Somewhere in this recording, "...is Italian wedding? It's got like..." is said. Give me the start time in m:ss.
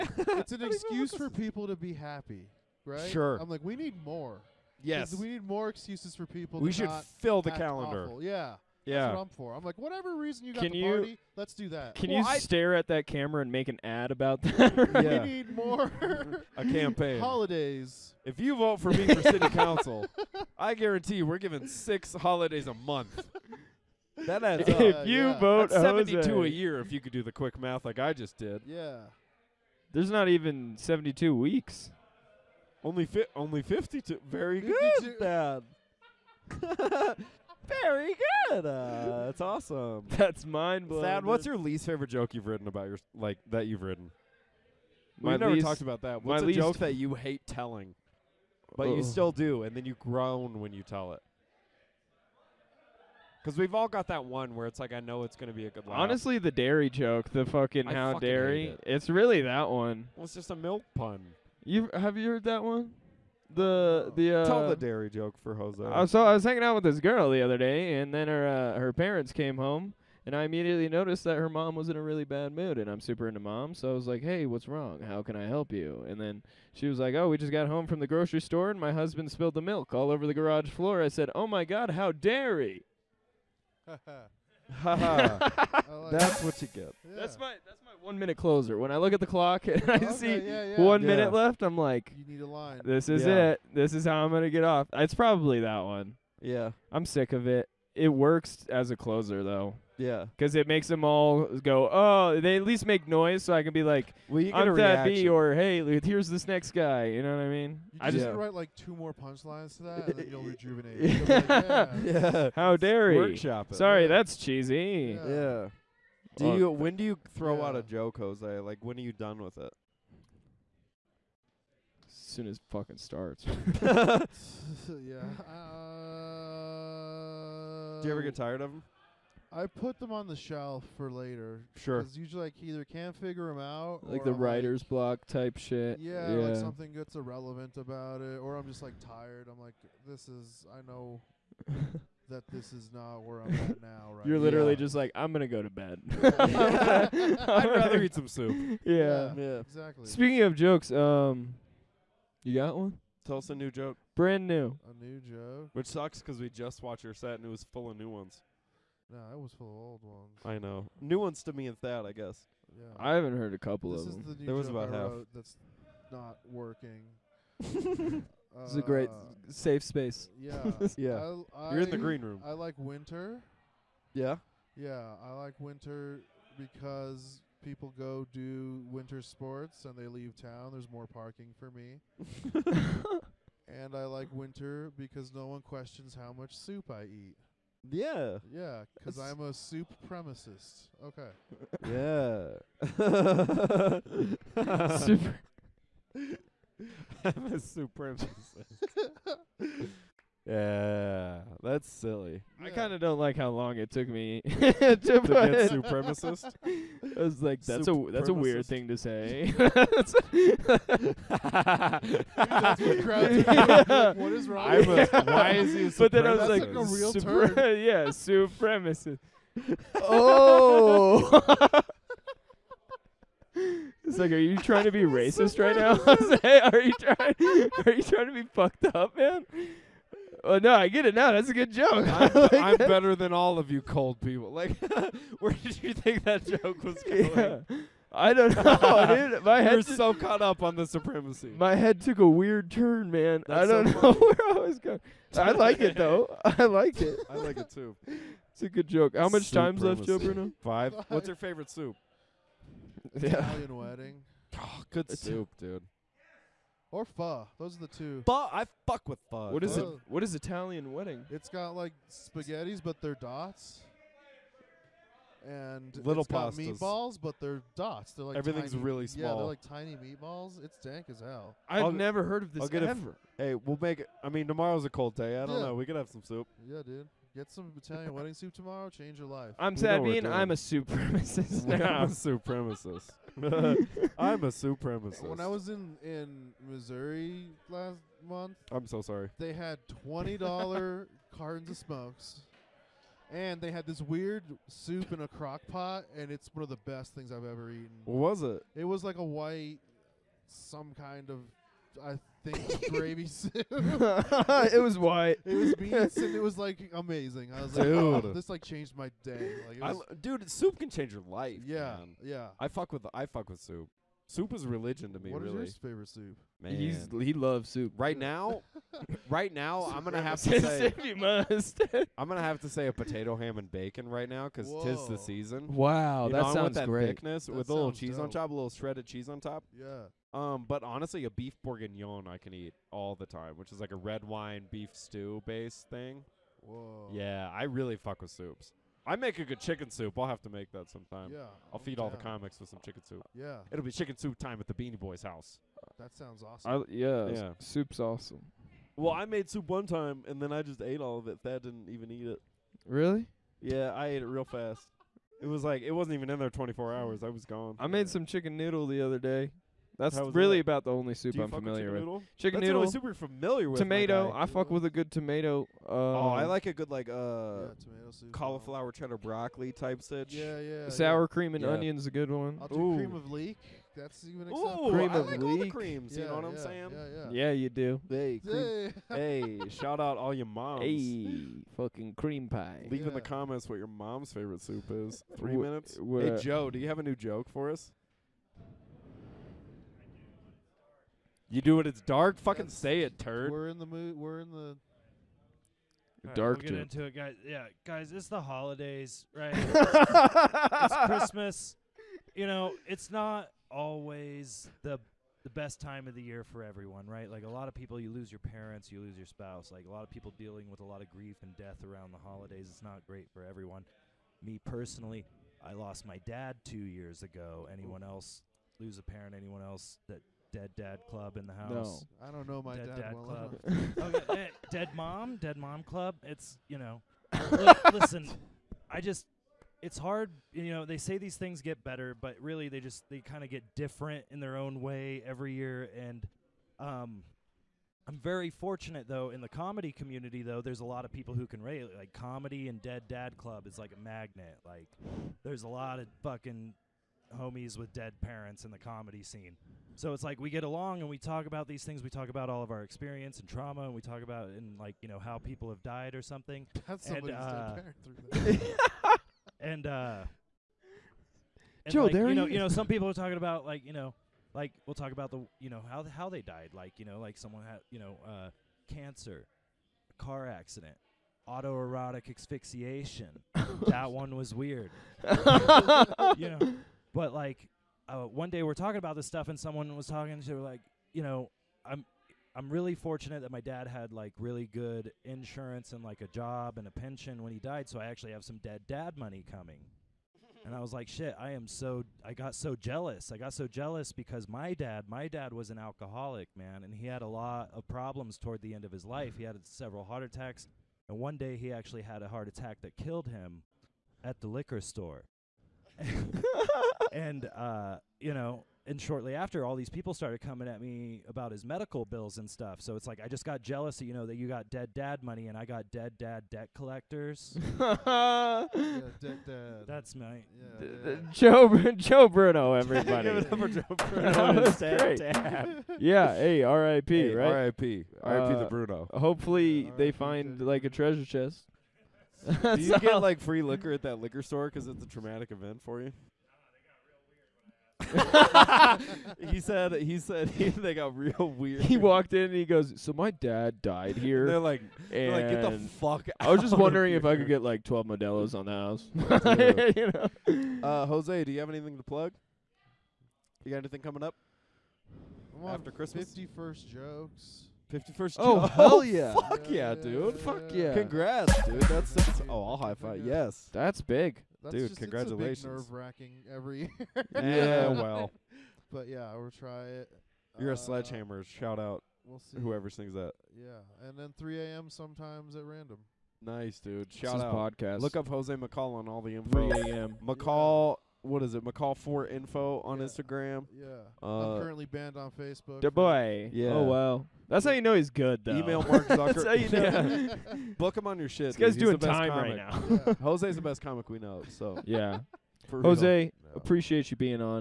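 4:20.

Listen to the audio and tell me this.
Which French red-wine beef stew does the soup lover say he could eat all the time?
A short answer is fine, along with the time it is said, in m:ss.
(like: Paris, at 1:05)
Beef bourguignon, at 5:31.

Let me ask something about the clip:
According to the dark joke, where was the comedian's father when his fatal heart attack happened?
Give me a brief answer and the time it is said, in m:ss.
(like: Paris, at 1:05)
the liquor store, at 8:24.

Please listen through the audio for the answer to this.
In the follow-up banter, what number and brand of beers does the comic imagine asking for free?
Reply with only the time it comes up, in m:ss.
9:07.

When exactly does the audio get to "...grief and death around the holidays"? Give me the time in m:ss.
6:51.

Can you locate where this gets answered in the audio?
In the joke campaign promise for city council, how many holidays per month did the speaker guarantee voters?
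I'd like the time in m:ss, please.
0:21.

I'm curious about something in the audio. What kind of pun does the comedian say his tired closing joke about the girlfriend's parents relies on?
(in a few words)
a milk pun.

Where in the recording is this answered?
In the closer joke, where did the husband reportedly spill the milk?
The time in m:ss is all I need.
1:20.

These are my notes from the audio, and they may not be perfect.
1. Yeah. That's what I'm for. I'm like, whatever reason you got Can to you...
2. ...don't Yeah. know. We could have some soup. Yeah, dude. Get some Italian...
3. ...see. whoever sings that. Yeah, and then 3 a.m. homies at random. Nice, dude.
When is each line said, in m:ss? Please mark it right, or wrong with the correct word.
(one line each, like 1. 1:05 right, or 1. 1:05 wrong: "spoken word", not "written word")
1. 0:08 right
2. 4:35 right
3. 9:32 wrong: "sometimes", not "homies".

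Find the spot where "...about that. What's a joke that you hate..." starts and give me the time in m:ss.
0:45.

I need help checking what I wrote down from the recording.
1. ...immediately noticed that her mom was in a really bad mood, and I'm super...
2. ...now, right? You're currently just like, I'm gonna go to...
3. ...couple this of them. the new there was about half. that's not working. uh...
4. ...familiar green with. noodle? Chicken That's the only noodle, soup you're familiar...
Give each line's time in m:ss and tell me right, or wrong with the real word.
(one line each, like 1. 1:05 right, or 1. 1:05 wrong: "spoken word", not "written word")
1. 1:10 right
2. 2:23 wrong: "literally", not "currently"
3. 2:43 right
4. 6:01 wrong: "chicken", not "green".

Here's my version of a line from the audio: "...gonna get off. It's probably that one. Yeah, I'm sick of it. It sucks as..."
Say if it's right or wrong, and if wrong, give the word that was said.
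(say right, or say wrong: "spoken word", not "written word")
wrong: "works", not "sucks".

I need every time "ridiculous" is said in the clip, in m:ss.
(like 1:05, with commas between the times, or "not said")
not said.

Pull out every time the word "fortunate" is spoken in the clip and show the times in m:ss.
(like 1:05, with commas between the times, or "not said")
7:18, 8:02.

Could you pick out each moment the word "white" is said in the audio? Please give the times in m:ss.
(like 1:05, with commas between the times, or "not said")
4:59, 5:04.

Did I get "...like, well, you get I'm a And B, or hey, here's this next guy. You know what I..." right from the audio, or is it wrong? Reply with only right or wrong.
wrong.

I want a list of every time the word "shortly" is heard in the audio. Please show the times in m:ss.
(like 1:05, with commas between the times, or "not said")
8:29.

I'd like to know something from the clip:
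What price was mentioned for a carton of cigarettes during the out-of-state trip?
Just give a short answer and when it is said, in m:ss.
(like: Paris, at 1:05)
$20, at 4:50.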